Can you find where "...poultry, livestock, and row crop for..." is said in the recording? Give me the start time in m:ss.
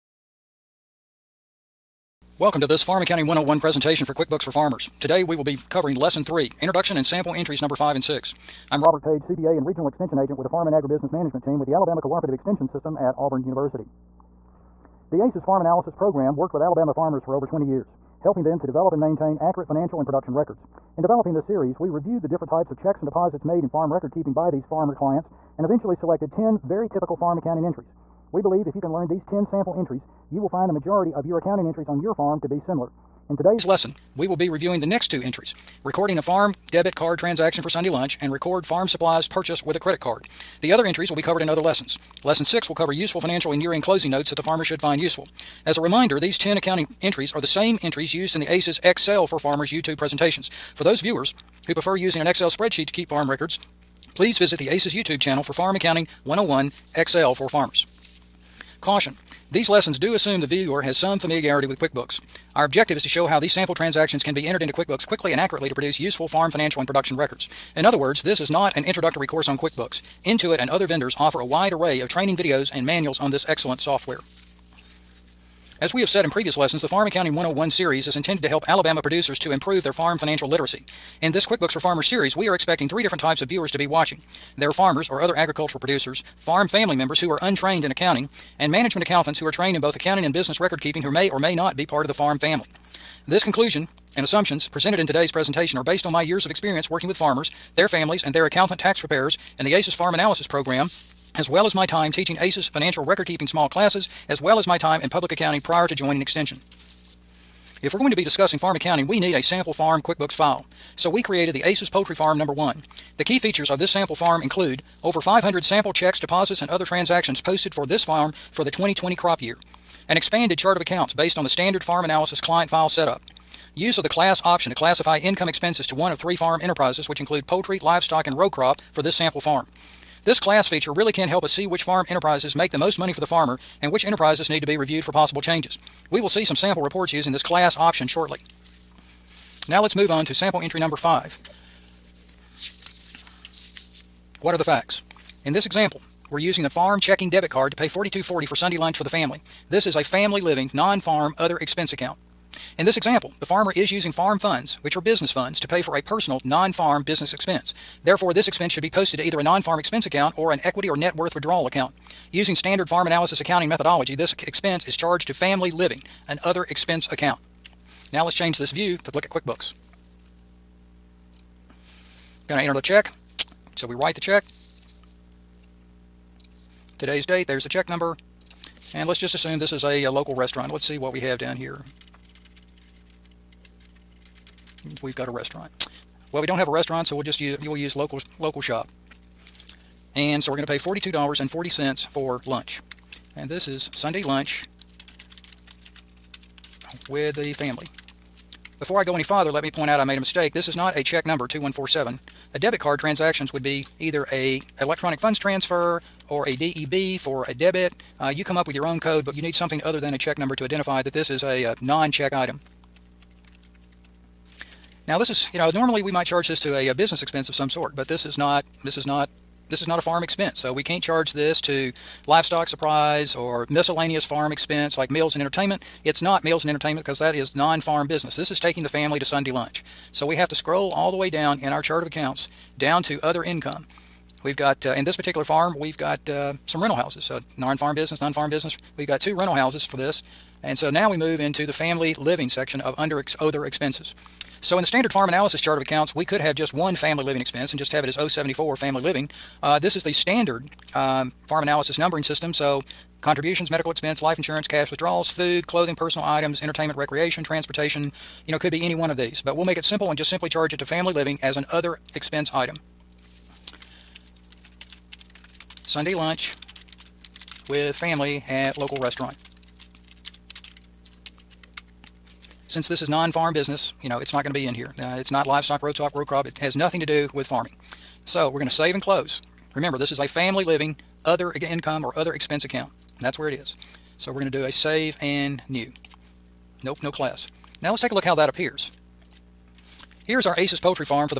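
2:07.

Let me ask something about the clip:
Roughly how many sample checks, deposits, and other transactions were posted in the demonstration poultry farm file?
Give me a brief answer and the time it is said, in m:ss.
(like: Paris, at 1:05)
over 500, at 1:55.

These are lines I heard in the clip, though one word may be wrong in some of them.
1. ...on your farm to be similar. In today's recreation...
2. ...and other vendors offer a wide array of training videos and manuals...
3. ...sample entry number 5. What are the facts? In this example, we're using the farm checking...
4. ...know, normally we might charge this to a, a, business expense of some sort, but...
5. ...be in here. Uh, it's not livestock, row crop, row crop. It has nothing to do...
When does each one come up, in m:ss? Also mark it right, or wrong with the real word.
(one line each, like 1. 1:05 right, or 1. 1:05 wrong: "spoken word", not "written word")
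1. 0:31 wrong: "lesson", not "recreation"
2. 1:10 right
3. 2:20 right
4. 3:35 right
5. 4:34 right.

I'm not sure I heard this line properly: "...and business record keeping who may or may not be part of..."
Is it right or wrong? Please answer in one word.
right.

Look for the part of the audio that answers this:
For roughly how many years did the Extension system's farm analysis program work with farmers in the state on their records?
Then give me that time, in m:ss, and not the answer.
0:17.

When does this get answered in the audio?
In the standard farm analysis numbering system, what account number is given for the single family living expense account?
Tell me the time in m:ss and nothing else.
4:08.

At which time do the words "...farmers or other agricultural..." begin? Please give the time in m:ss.
1:24.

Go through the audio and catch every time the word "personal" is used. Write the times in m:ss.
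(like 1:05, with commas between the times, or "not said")
2:36, 4:15.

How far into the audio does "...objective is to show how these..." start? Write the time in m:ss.
1:02.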